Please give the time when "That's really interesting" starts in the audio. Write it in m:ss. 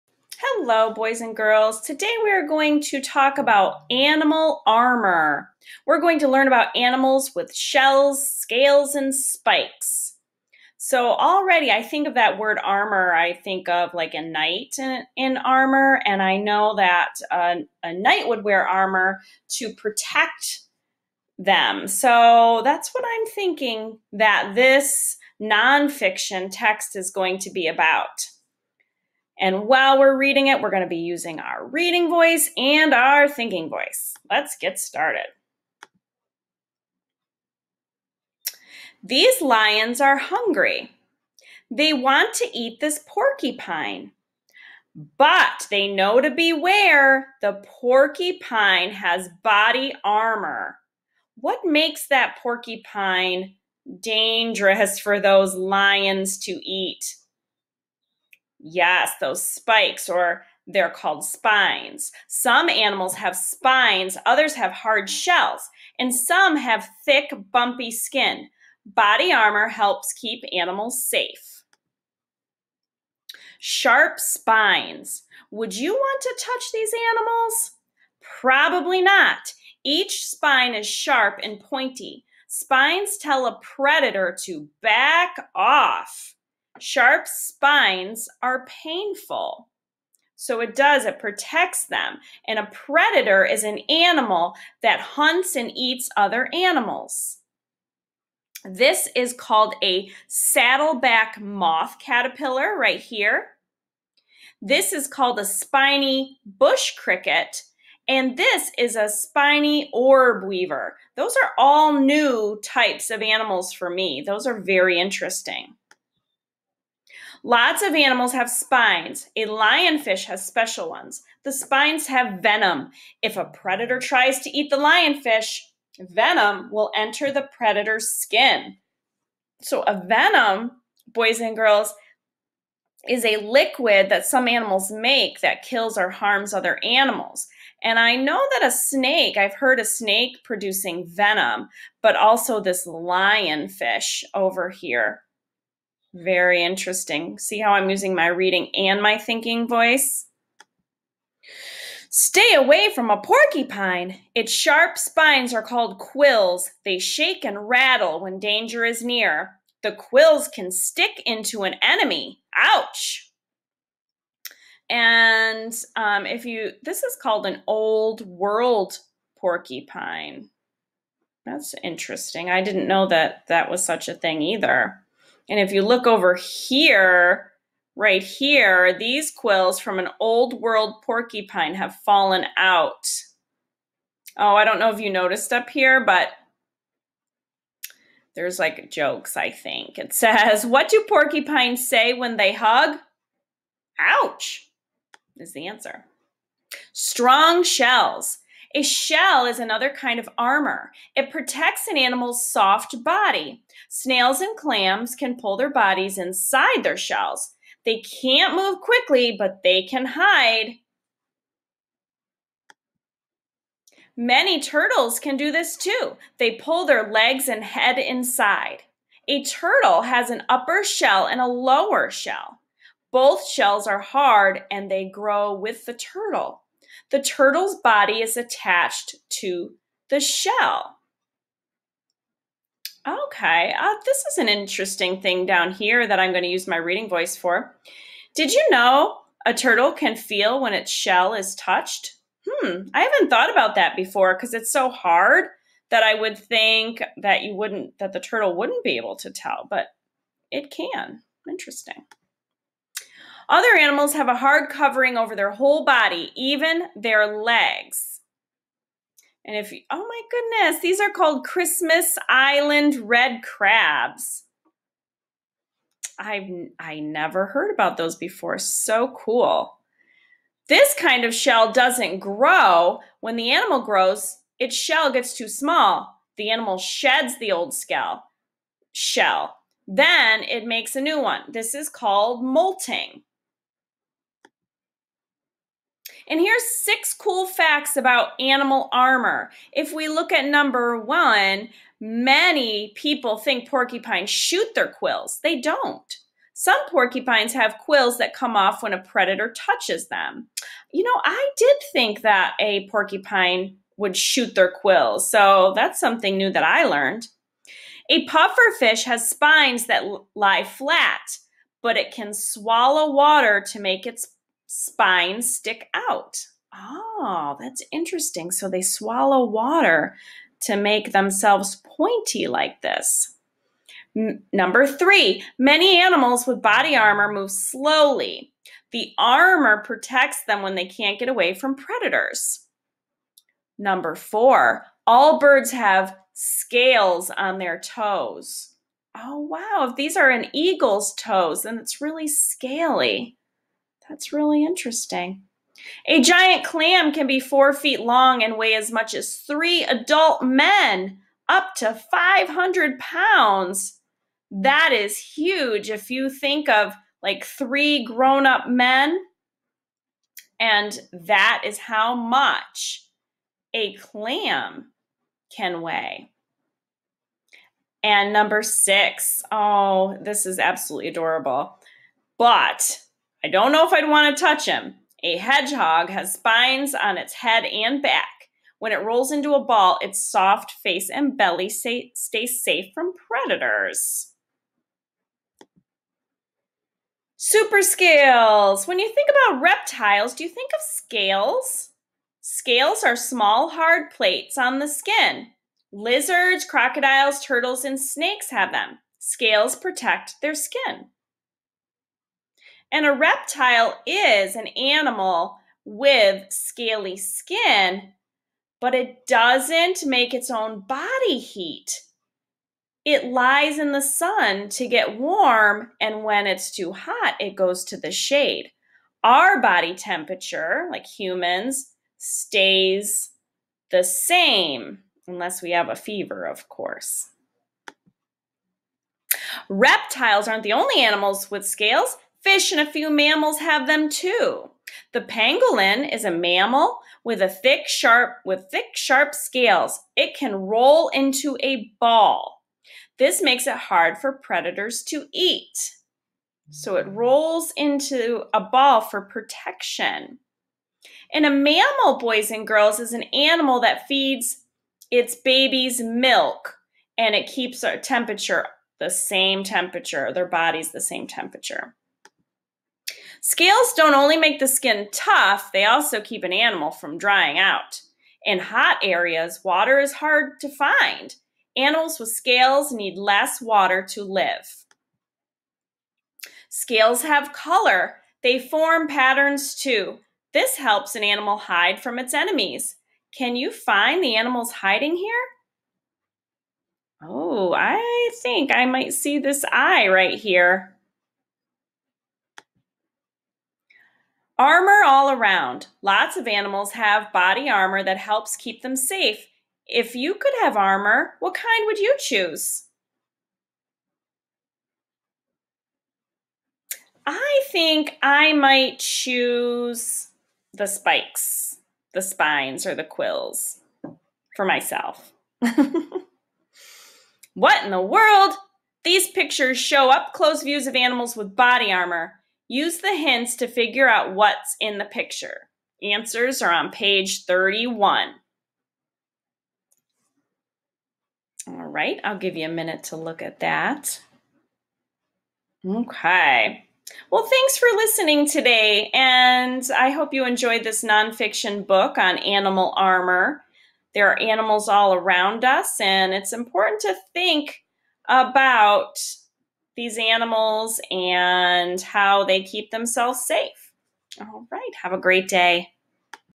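5:44.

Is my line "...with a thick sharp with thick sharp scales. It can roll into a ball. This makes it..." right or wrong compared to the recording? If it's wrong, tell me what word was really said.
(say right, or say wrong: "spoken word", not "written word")
right.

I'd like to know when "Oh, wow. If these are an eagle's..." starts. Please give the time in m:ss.
5:39.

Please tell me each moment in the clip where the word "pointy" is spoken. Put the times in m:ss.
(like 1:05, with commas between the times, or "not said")
1:21, 5:21.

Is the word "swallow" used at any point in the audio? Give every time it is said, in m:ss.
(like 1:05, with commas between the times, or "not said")
5:12, 5:18.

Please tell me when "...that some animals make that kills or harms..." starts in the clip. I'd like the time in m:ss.
2:14.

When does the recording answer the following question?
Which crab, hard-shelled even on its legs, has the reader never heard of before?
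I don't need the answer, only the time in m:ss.
4:21.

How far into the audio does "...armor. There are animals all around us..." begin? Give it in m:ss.
9:02.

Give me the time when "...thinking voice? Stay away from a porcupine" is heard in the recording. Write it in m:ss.
2:29.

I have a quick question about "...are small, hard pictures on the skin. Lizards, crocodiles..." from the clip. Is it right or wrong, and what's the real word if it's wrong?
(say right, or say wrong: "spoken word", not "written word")
wrong: "plates", not "pictures".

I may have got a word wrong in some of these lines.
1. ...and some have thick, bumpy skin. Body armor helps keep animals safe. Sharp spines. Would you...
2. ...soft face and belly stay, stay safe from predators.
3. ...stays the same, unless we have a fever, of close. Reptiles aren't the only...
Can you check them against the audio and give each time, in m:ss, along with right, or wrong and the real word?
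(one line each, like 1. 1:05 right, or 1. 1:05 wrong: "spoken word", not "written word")
1. 1:05 right
2. 6:20 right
3. 7:02 wrong: "course", not "close".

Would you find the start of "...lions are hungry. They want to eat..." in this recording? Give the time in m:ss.
0:39.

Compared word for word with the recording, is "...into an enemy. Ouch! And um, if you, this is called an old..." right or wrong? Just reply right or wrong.
right.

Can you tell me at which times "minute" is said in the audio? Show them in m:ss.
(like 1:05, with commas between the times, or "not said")
8:52.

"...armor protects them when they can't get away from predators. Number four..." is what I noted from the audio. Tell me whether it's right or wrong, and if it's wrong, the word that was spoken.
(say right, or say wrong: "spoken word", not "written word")
right.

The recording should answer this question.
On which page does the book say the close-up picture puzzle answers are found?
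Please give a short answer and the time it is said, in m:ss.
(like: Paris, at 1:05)
Page 31, at 8:46.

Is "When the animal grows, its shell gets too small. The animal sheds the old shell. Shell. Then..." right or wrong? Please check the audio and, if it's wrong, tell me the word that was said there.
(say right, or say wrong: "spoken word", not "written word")
right.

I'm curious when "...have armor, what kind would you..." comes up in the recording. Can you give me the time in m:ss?
8:20.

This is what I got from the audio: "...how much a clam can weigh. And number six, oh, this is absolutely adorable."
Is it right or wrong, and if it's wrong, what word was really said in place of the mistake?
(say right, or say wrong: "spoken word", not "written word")
right.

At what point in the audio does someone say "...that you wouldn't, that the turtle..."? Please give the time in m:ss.
4:07.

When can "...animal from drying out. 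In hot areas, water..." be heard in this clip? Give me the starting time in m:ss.
7:46.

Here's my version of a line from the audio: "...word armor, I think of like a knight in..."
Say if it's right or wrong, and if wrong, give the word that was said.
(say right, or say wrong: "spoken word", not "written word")
right.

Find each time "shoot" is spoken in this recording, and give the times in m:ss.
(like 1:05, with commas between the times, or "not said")
4:54, 5:04.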